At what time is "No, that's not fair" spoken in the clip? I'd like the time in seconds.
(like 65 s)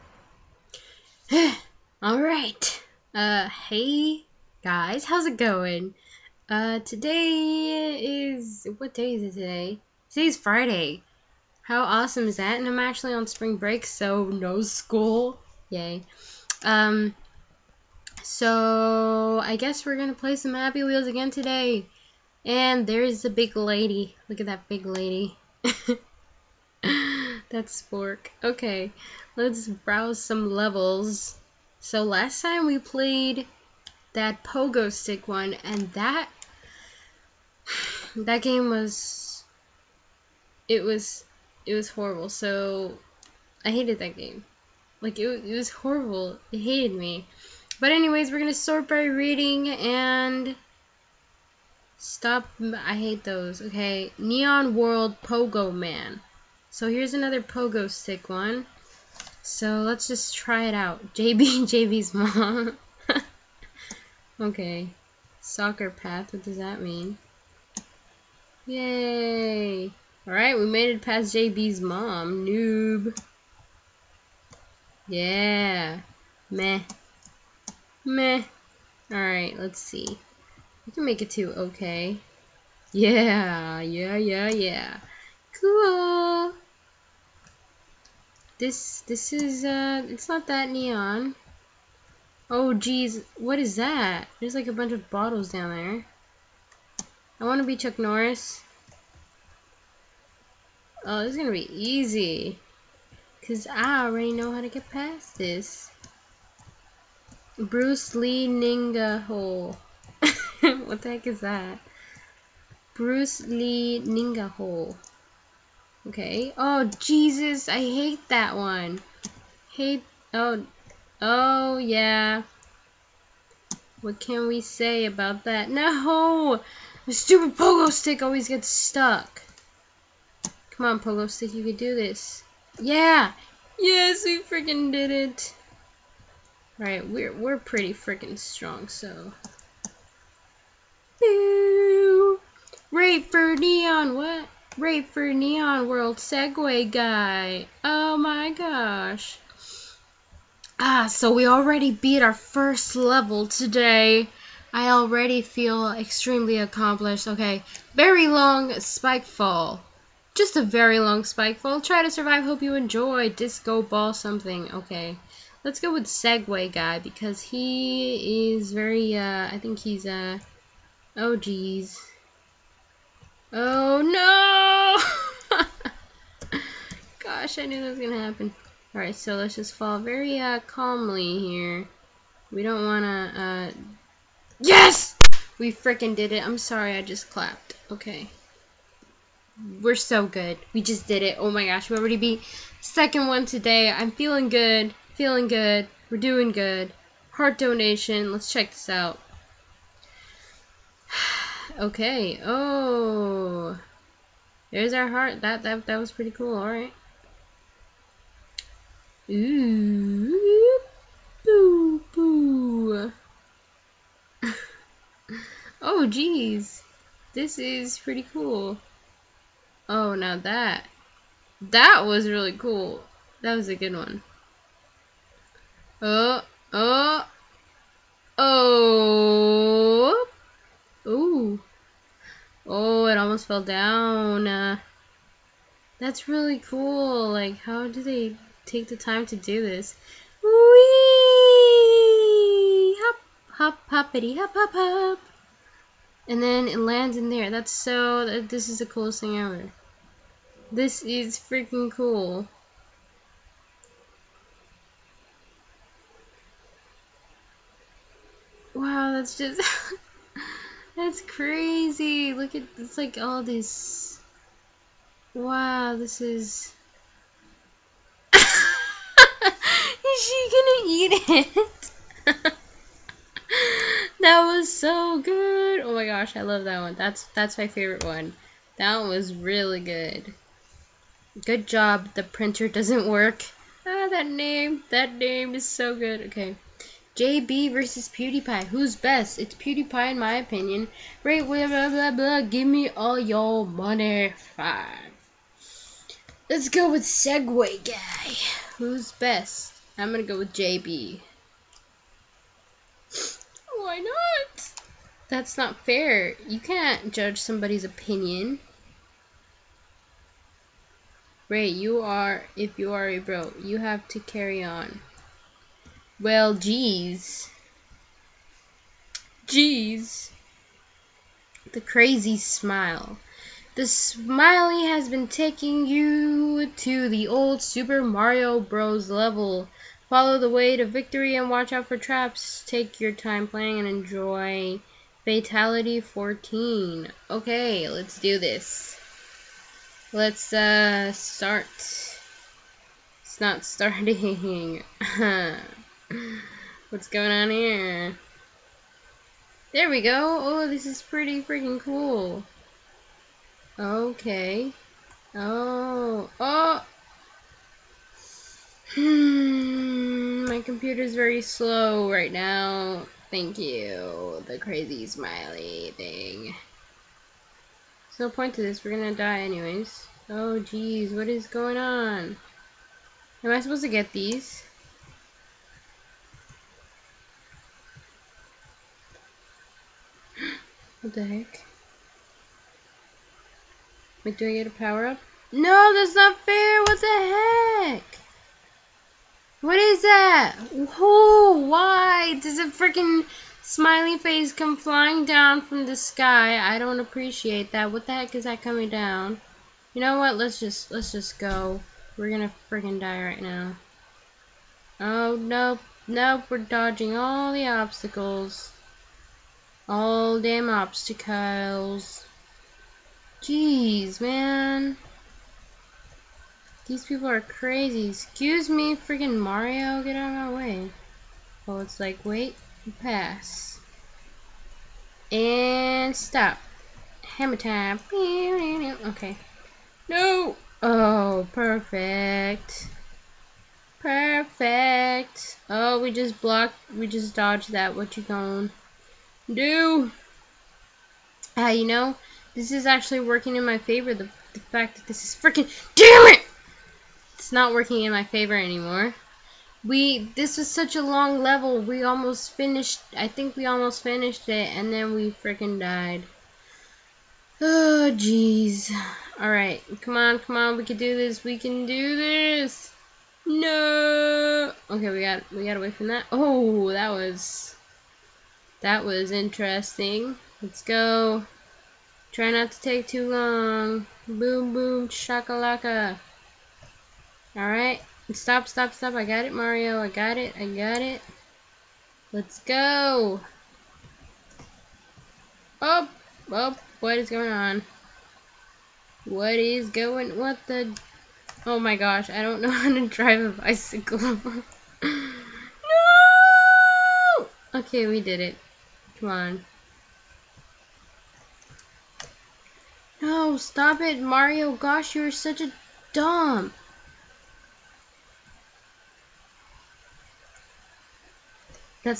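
385 s.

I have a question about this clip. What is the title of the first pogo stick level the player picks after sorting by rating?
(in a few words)
Neon World Pogo Man.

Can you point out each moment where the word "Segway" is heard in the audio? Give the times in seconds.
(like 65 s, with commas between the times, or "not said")
146 s, 166 s, 297 s.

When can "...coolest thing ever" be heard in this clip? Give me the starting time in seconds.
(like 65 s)
248 s.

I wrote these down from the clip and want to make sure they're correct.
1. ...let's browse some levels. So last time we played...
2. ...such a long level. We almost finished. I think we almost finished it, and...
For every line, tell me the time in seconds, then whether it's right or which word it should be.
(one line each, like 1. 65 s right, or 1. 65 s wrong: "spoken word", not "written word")
1. 29 s right
2. 450 s right.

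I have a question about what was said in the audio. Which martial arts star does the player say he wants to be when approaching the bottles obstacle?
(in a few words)
Chuck Norris.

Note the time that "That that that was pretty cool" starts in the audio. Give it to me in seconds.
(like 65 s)
205 s.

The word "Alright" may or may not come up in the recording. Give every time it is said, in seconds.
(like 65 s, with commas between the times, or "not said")
70 s, 79 s, 178 s, 477 s.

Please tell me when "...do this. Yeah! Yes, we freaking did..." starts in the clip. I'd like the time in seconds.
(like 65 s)
131 s.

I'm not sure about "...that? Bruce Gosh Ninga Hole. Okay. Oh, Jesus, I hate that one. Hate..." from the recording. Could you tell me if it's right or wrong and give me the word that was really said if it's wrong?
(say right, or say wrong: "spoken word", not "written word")
wrong: "Lee", not "Gosh".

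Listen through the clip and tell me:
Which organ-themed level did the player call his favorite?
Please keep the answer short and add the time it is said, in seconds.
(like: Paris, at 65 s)
Heart donation, at 197 s.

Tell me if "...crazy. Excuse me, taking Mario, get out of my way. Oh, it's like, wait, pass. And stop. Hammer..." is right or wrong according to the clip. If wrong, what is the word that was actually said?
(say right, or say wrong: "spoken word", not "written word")
wrong: "freaking", not "taking".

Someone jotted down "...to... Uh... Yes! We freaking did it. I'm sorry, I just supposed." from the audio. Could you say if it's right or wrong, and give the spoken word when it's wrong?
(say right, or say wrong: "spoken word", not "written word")
wrong: "clapped", not "supposed".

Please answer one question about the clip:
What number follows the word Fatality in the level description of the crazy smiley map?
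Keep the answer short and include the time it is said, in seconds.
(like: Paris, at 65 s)
14, at 335 s.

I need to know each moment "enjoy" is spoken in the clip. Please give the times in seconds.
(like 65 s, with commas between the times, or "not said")
162 s, 333 s.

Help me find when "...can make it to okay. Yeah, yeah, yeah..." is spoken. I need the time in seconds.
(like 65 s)
80 s.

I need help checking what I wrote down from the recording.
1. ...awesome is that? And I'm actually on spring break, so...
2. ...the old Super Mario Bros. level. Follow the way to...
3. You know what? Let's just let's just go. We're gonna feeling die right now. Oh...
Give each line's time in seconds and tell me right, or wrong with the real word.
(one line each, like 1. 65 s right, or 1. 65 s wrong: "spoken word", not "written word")
1. 11 s right
2. 327 s right
3. 399 s wrong: "freaking", not "feeling".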